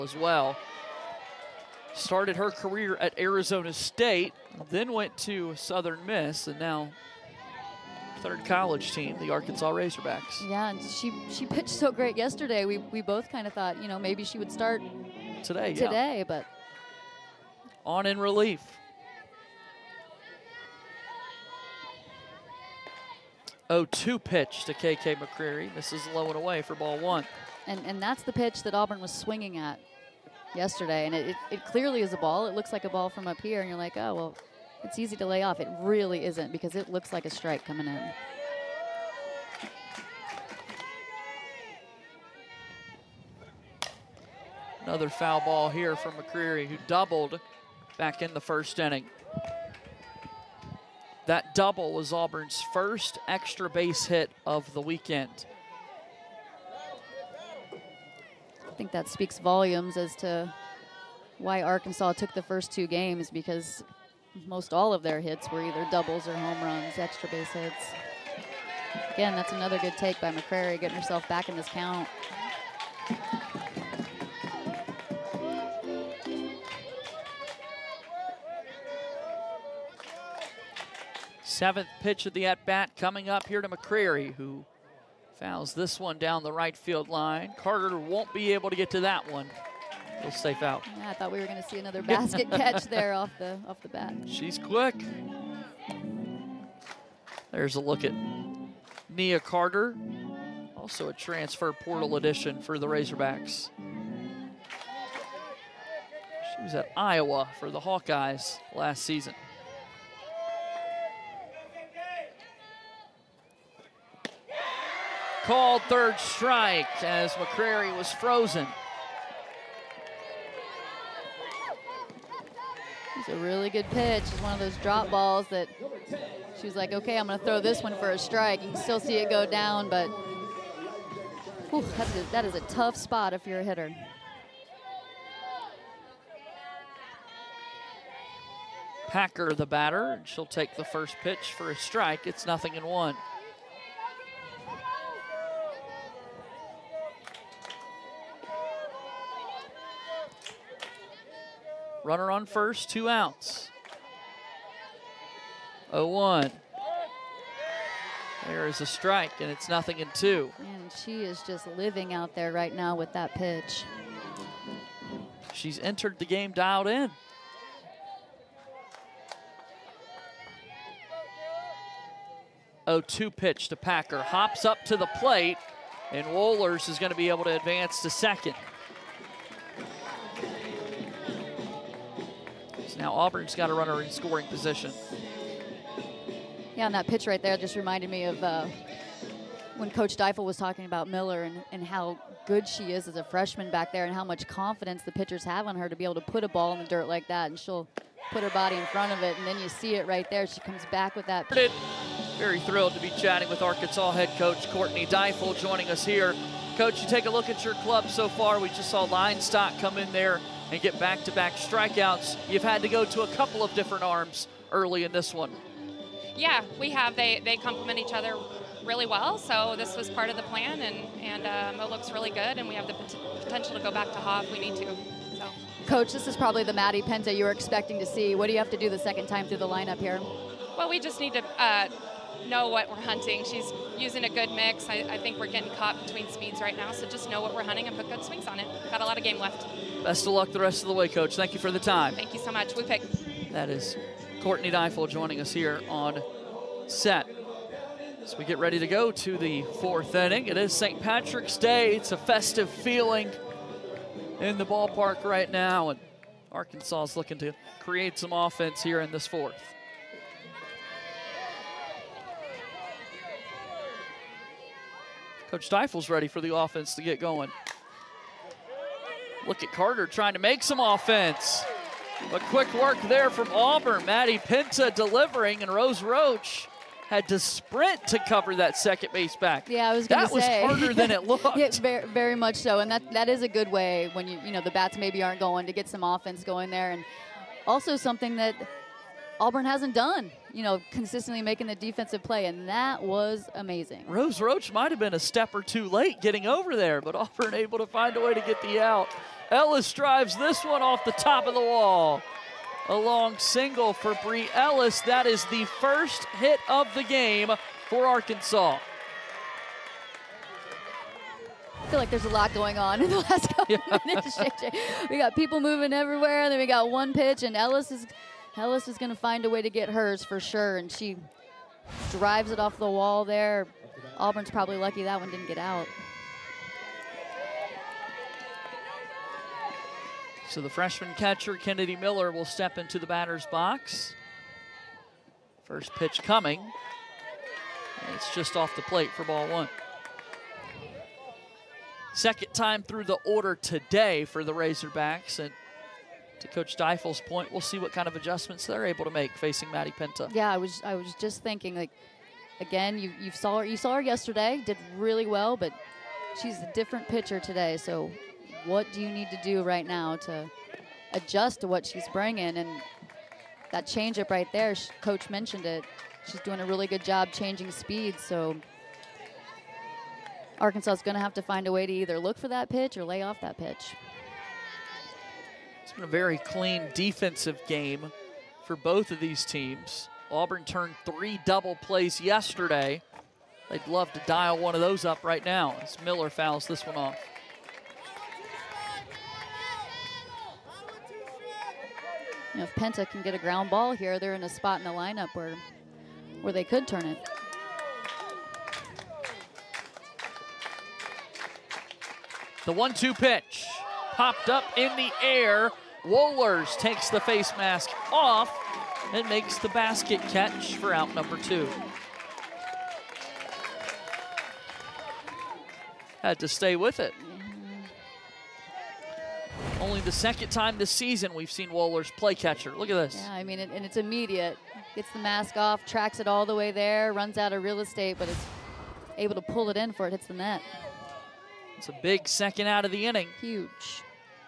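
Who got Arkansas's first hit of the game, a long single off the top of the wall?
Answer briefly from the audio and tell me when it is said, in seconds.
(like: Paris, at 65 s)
Bri Ellis, at 304 s.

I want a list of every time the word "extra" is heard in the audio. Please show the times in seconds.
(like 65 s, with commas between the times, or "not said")
53 s, 66 s.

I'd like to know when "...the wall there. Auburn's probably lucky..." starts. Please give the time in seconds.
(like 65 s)
322 s.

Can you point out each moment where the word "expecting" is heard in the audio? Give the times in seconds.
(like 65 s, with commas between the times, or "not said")
227 s.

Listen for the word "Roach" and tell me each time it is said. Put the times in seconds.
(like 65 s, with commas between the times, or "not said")
276 s, 294 s.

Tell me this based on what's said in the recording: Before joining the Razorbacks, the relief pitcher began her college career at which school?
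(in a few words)
Arizona State.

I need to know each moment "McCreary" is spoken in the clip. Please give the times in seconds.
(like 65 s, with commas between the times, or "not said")
25 s, 46 s, 70 s, 83 s, 117 s.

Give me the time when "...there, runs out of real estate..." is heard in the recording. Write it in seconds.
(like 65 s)
426 s.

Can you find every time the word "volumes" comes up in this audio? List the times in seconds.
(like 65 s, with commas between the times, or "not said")
59 s.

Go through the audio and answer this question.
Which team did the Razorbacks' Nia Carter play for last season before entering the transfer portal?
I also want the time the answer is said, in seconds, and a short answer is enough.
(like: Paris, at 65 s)
Iowa, at 106 s.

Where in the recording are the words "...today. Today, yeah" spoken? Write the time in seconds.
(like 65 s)
15 s.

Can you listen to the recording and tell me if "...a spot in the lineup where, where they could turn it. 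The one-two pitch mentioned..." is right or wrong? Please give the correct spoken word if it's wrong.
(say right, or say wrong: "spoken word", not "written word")
wrong: "popped", not "mentioned".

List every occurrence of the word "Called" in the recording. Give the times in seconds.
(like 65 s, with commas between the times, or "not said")
115 s.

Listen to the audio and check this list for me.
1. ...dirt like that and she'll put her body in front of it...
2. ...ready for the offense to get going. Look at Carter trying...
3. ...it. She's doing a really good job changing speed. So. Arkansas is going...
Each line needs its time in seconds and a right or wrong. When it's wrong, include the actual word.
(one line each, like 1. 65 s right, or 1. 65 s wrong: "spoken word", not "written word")
1. 196 s right
2. 266 s right
3. 365 s right.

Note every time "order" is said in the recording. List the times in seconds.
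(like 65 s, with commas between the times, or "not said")
343 s.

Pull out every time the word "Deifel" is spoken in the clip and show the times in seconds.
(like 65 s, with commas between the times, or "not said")
190 s, 205 s, 244 s, 265 s, 346 s.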